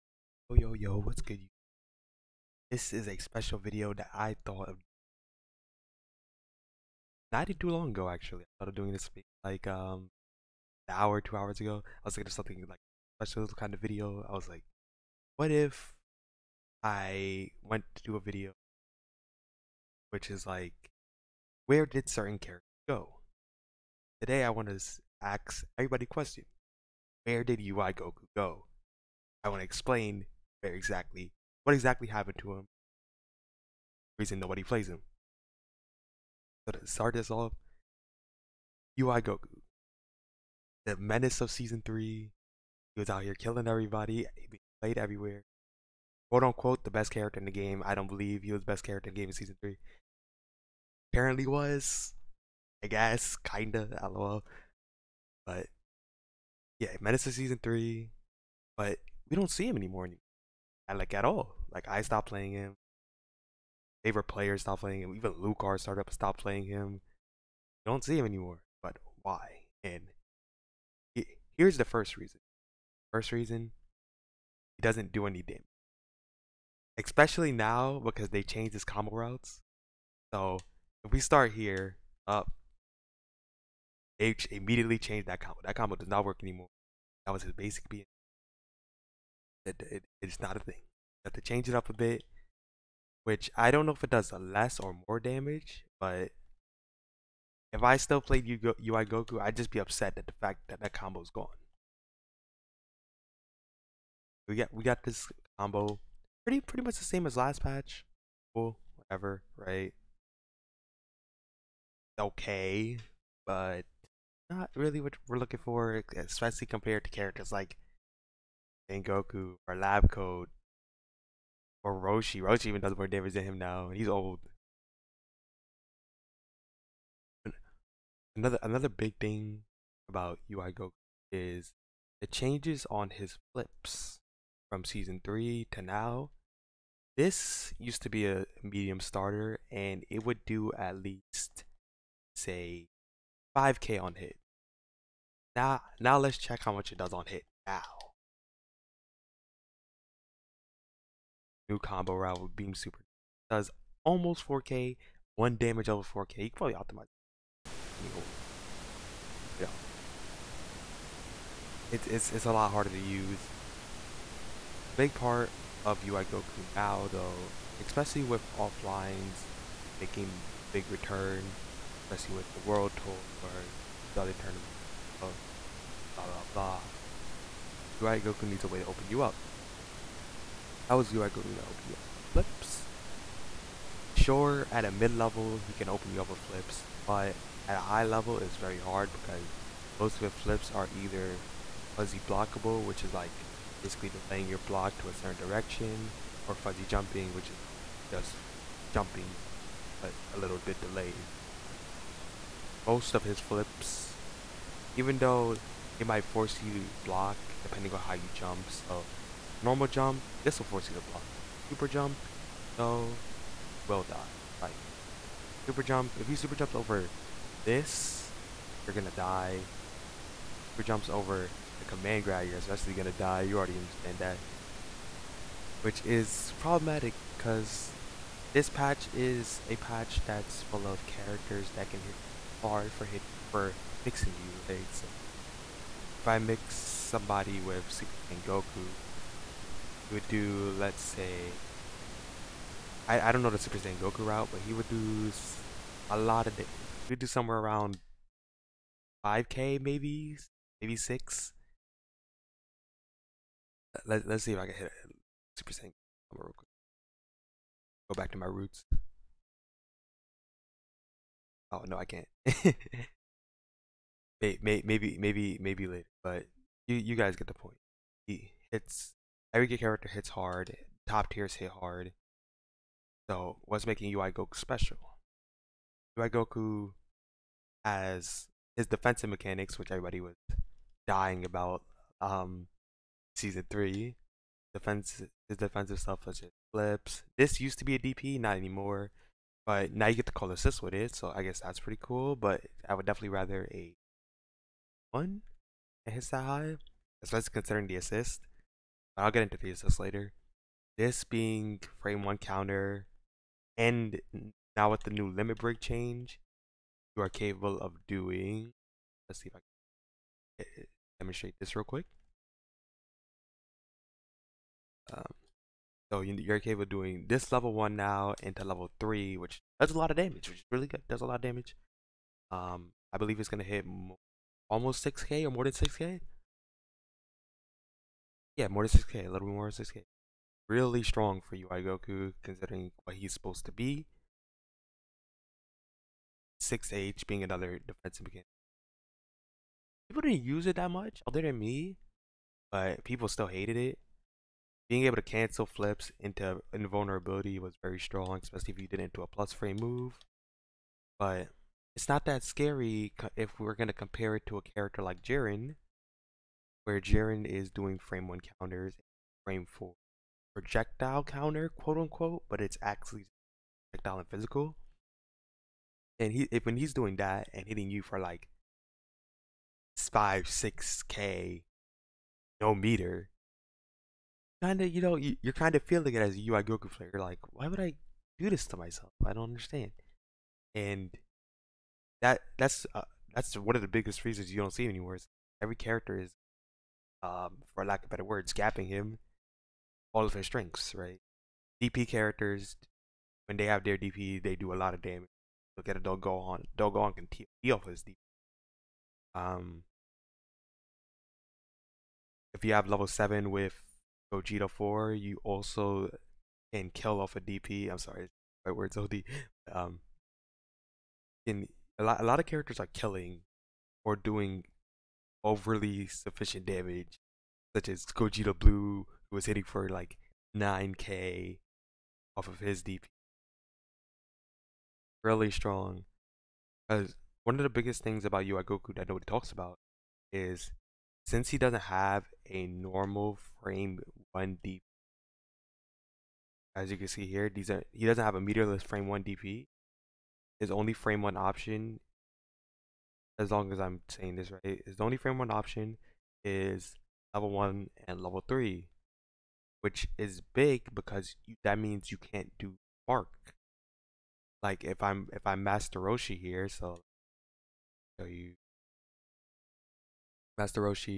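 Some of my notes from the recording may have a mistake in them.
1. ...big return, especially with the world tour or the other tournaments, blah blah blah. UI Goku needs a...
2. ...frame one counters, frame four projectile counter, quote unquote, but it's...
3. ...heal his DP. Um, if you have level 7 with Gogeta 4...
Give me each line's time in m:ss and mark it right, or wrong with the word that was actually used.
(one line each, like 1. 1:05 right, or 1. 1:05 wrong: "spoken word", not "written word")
1. 2:50 right
2. 5:57 right
3. 6:37 right.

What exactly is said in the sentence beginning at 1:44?
We got we got this combo pretty pretty much the same as last patch.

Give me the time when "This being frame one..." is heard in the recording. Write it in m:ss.
5:00.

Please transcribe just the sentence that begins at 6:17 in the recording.
You're like, why would I do this to myself?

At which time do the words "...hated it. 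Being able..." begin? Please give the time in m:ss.
5:43.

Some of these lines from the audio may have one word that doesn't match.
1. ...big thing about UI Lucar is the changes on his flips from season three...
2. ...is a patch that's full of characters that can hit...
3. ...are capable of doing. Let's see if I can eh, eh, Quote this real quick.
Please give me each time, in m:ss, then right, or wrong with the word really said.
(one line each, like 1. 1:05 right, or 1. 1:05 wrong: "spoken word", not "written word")
1. 2:08 wrong: "Goku", not "Lucar"
2. 3:49 right
3. 5:07 wrong: "demonstrate", not "Quote".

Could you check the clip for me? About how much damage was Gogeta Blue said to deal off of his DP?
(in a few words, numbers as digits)
9k.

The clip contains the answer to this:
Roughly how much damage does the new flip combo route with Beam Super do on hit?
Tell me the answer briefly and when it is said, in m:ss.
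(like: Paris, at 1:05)
almost 4K, at 2:34.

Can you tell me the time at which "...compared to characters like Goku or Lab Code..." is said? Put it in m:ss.
1:56.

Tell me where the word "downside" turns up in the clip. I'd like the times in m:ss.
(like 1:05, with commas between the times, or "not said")
not said.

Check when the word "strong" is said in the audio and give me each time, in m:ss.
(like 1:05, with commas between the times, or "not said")
5:31, 5:47, 7:05.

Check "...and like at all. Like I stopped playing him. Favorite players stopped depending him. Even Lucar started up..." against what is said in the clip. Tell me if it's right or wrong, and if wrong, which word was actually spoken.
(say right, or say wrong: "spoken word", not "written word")
wrong: "playing", not "depending".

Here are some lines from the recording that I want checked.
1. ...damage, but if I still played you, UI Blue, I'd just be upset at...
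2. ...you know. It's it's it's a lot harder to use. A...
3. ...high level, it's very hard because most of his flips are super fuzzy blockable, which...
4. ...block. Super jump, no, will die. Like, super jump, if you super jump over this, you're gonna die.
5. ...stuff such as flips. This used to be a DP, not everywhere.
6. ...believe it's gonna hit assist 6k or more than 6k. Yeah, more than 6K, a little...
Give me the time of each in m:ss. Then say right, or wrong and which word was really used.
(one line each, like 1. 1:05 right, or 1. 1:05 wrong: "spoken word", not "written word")
1. 1:35 wrong: "Goku", not "Blue"
2. 2:39 right
3. 3:07 wrong: "either", not "super"
4. 3:31 right
5. 4:45 wrong: "anymore", not "everywhere"
6. 5:23 wrong: "almost", not "assist".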